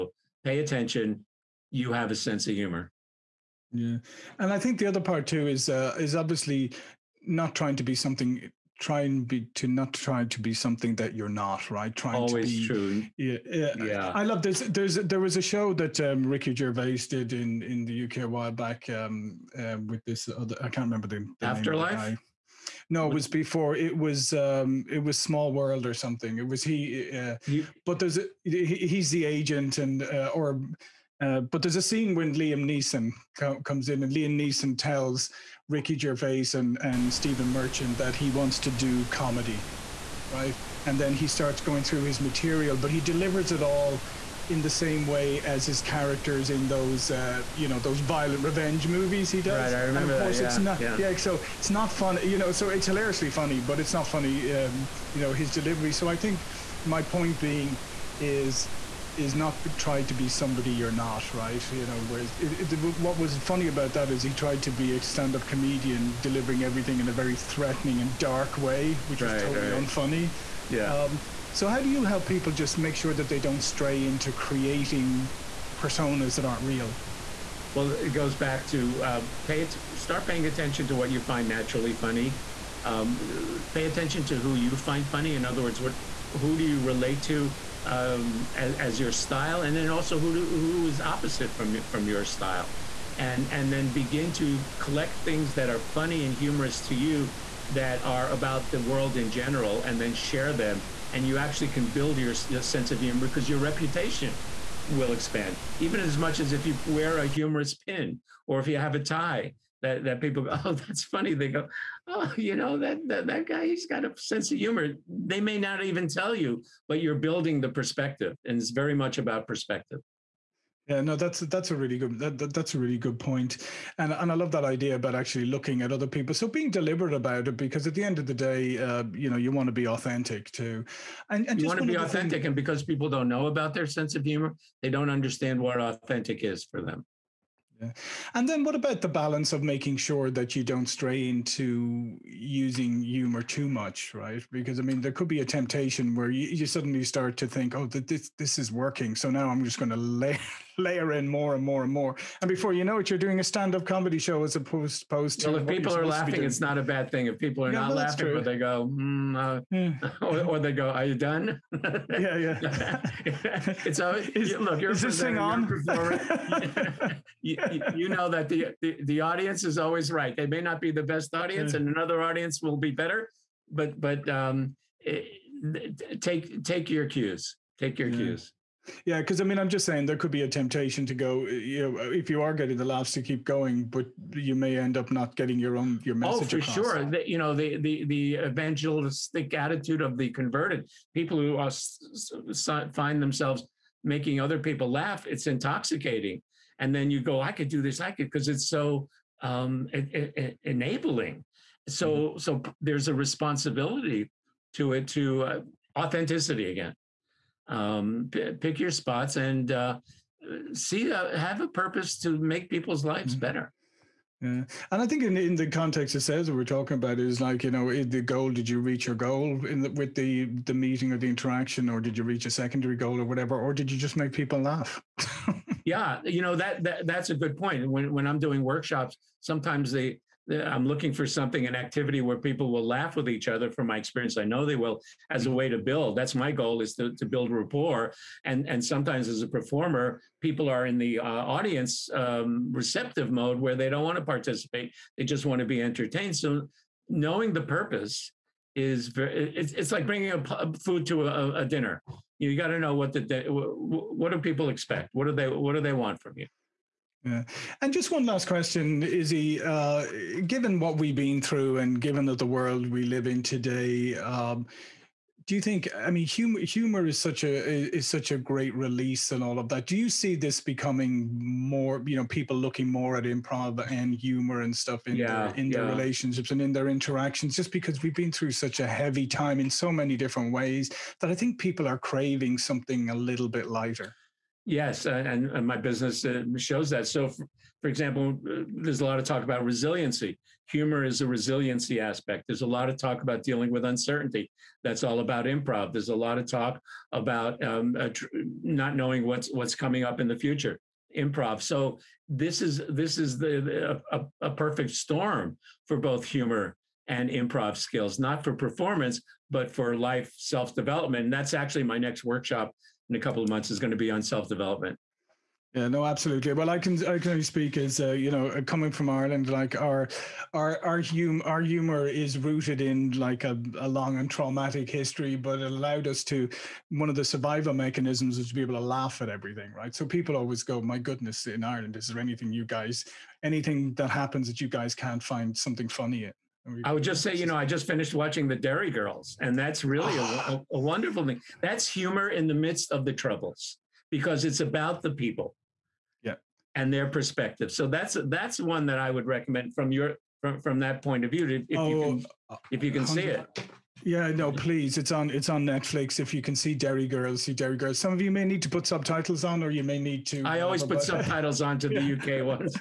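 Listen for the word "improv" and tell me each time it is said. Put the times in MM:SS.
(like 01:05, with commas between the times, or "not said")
04:33, 04:55, 05:01, 05:07.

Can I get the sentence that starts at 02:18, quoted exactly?
And then what about the balance of making sure that you don't stray into using humor too much, right?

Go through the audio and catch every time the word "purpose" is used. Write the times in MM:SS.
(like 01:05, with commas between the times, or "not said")
03:31, 04:07.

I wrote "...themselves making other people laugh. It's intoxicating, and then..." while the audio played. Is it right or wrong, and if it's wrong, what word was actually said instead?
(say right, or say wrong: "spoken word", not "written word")
right.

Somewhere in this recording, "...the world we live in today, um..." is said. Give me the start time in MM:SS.
04:22.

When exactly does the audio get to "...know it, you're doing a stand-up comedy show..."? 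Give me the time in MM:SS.
02:32.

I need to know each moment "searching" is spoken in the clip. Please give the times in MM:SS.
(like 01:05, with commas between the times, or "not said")
not said.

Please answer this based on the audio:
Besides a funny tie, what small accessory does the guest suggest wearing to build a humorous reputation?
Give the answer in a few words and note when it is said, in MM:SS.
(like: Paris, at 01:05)
A humorous pin, at 01:47.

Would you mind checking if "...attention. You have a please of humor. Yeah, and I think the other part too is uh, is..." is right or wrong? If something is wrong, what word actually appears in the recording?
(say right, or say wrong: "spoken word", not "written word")
wrong: "sense", not "please".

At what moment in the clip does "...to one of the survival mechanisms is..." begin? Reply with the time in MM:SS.
05:26.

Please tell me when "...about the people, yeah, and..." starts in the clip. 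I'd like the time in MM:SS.
05:44.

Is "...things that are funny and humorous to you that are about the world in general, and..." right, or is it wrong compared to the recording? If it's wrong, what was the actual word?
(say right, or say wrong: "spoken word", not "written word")
right.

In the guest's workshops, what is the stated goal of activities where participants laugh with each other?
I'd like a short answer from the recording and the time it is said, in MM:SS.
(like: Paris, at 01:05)
To build rapport, at 03:57.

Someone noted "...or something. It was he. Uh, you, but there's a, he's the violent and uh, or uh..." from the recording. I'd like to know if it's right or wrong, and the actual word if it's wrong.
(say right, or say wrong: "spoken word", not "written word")
wrong: "agent", not "violent".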